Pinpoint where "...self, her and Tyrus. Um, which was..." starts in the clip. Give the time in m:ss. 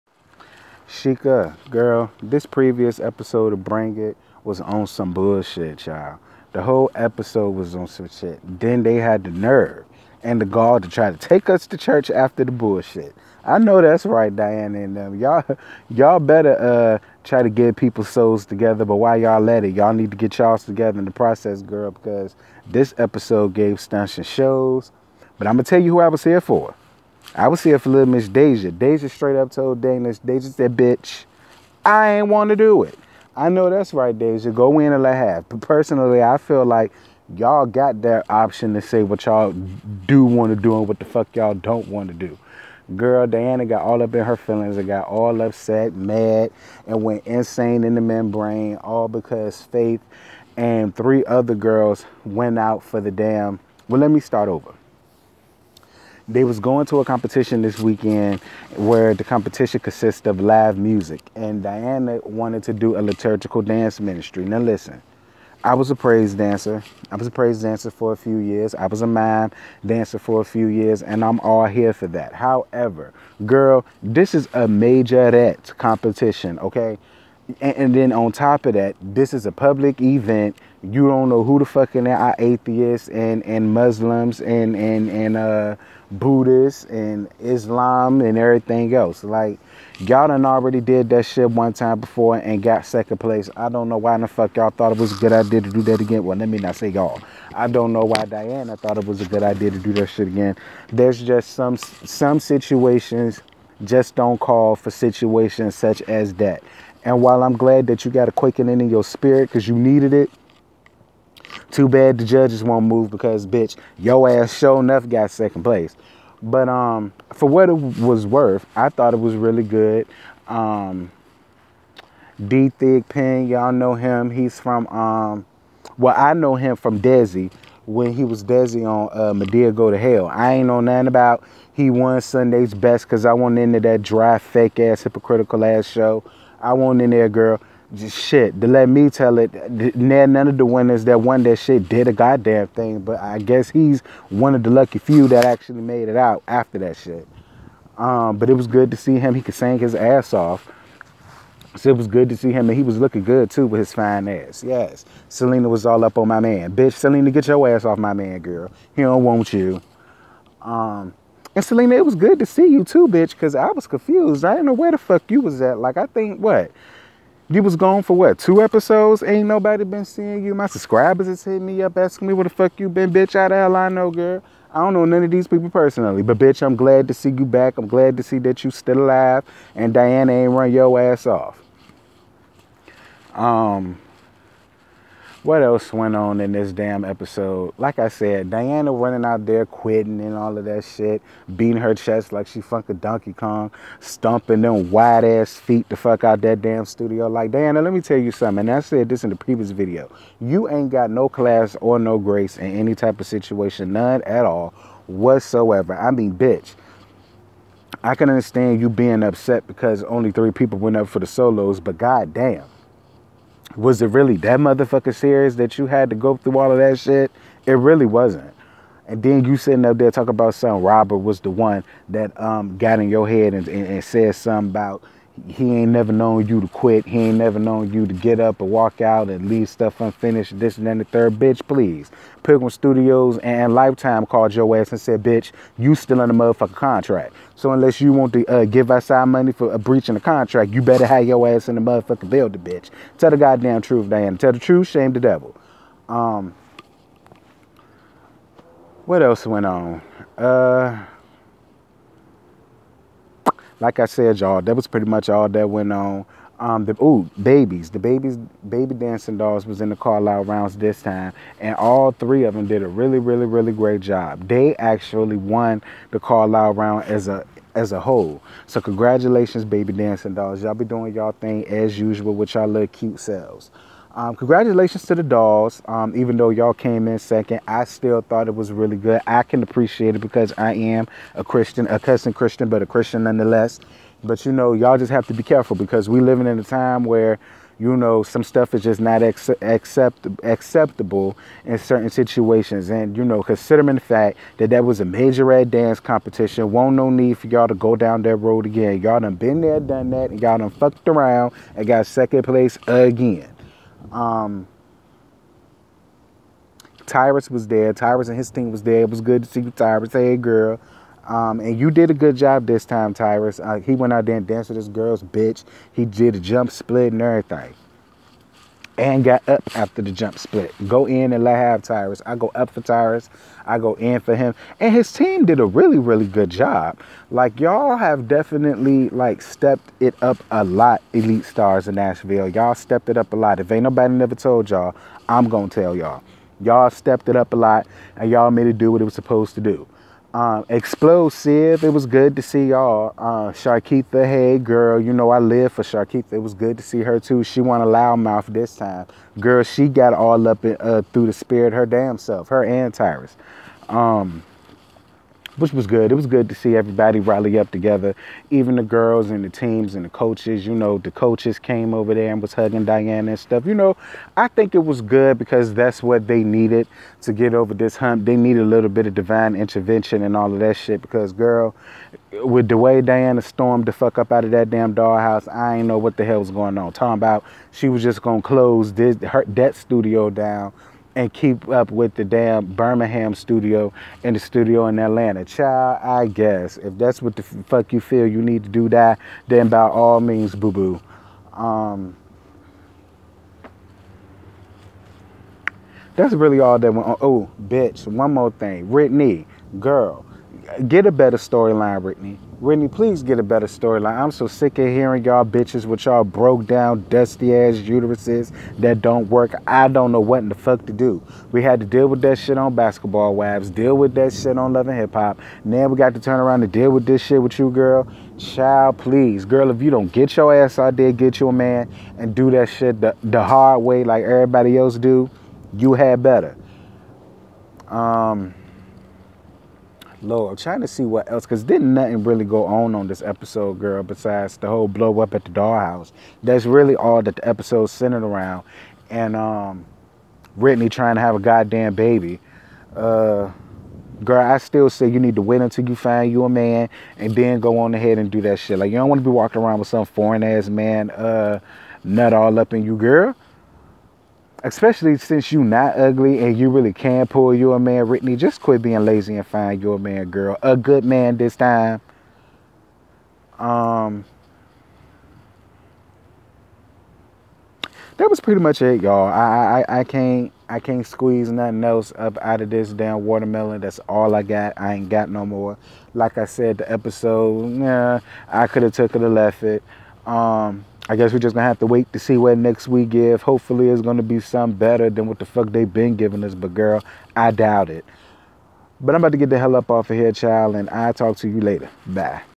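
5:52.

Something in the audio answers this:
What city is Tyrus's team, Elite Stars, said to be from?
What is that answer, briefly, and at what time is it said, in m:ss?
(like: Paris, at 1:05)
Nashville, at 5:31.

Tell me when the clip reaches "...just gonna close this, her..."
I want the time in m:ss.
6:18.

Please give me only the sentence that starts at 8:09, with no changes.
But I'm about to get the hell up off of here, child, and I'll talk to you later.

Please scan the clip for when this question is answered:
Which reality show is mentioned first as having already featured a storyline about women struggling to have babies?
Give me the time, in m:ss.
6:52.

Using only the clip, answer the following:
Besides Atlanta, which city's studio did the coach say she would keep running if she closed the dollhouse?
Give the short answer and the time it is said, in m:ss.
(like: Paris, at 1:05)
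Birmingham, at 6:22.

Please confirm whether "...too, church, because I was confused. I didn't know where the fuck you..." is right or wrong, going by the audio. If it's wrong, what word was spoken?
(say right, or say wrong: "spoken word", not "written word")
wrong: "bitch", not "church".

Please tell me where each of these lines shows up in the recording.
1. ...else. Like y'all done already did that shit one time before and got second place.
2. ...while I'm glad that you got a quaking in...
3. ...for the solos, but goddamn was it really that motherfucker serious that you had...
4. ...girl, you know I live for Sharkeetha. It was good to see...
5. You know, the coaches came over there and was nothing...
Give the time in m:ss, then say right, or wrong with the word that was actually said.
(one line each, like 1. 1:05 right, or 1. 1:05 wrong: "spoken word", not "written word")
1. 1:28 right
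2. 1:47 right
3. 3:31 right
4. 5:44 right
5. 6:00 wrong: "hugging", not "nothing".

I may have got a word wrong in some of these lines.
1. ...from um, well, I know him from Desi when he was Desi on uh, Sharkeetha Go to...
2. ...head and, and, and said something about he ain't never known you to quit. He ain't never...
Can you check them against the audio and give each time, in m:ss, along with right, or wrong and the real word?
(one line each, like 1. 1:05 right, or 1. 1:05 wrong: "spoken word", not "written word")
1. 2:04 wrong: "Madea", not "Sharkeetha"
2. 3:43 right.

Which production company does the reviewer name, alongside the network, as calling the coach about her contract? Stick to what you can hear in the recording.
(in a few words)
Pilgrim Studios.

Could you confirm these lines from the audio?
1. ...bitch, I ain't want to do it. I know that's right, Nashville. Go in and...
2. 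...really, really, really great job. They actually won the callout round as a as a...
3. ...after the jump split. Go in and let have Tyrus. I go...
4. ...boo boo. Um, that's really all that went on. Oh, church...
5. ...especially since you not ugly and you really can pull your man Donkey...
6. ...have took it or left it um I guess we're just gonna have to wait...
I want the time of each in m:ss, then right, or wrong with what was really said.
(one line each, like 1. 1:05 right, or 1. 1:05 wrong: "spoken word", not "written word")
1. 0:30 wrong: "Deja", not "Nashville"
2. 4:22 right
3. 5:19 right
4. 6:30 wrong: "bitch", not "church"
5. 7:34 wrong: "Whitney", not "Donkey"
6. 7:58 right.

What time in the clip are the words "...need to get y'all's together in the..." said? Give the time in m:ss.
0:19.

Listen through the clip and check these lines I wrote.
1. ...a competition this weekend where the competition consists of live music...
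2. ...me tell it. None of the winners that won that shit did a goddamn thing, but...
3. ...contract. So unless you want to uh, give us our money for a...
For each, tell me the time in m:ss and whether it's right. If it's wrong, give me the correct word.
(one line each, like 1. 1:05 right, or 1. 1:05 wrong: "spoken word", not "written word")
1. 0:56 right
2. 2:18 right
3. 3:56 right.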